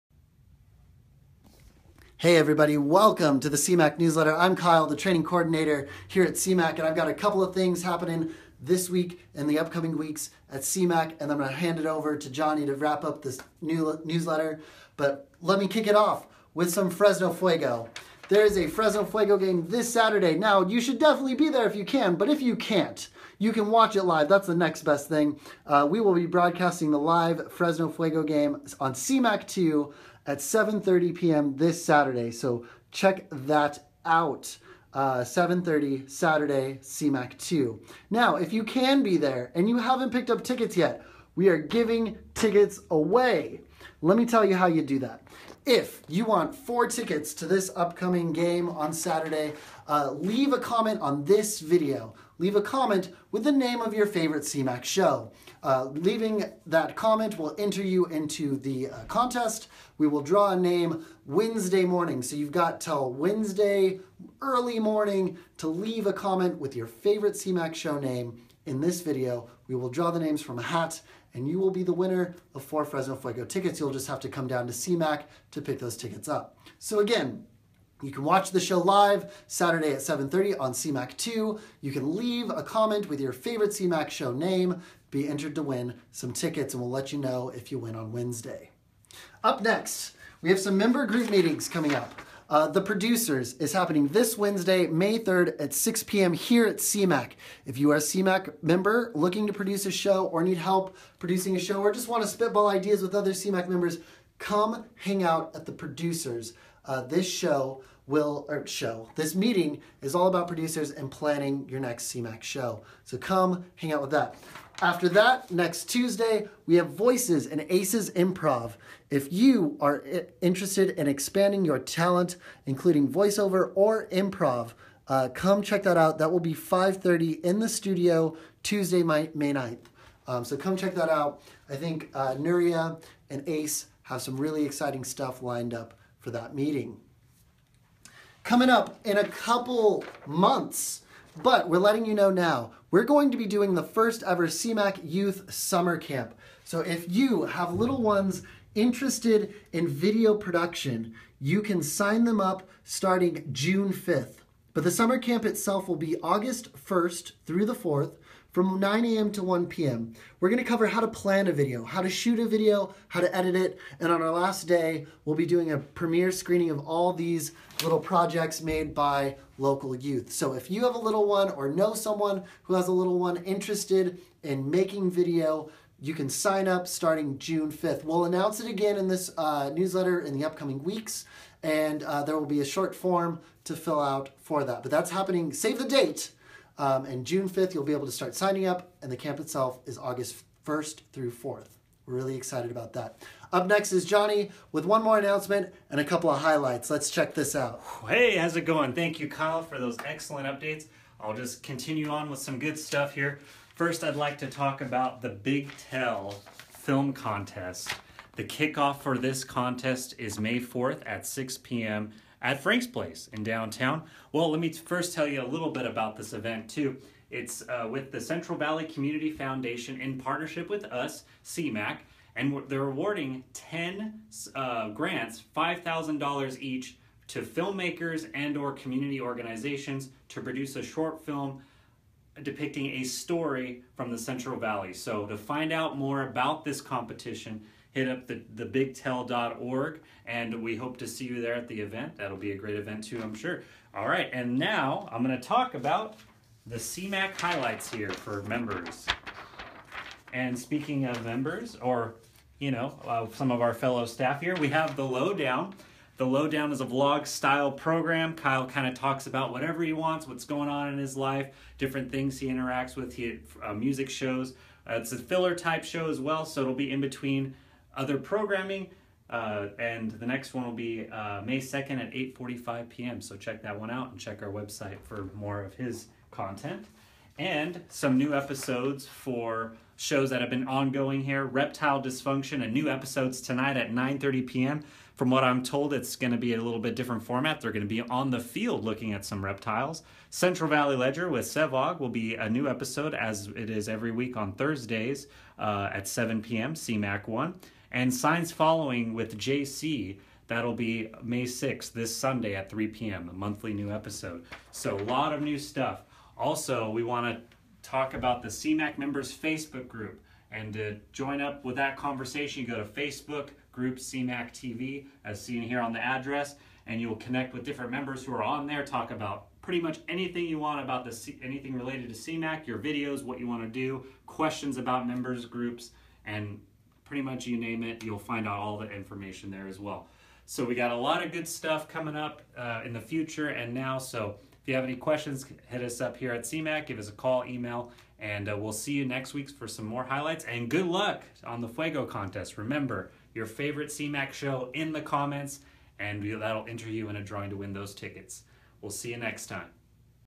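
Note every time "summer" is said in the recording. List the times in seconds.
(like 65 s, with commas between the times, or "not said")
145 s, 154 s.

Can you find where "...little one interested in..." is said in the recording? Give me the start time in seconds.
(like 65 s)
172 s.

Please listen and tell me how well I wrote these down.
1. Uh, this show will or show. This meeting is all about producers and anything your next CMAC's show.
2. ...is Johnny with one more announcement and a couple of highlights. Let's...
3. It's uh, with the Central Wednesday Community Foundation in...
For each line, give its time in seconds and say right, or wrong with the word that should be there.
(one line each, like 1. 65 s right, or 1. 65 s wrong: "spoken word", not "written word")
1. 106 s wrong: "planning", not "anything"
2. 193 s right
3. 217 s wrong: "Valley", not "Wednesday".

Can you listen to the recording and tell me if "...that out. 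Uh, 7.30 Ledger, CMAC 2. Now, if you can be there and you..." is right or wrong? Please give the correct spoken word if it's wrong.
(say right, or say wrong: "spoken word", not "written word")
wrong: "Saturday", not "Ledger".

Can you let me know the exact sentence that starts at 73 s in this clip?
You'll just have to come down to CMAC to pick those tickets up.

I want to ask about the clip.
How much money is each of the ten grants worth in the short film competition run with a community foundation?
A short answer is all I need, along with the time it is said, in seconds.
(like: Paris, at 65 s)
$5,000, at 225 s.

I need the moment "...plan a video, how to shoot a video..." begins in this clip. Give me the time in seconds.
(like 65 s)
161 s.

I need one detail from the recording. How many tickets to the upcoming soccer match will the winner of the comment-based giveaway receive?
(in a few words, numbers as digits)
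4.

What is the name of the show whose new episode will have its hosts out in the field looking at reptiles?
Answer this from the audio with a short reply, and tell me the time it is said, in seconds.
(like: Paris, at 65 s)
Reptile Dysfunction, at 281 s.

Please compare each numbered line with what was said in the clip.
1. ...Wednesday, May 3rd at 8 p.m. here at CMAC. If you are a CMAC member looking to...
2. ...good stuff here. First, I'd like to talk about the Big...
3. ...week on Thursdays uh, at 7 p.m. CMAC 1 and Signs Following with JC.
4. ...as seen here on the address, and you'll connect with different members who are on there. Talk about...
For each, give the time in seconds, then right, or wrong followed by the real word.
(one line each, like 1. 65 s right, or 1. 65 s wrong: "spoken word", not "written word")
1. 94 s wrong: "6", not "8"
2. 202 s right
3. 294 s right
4. 315 s right.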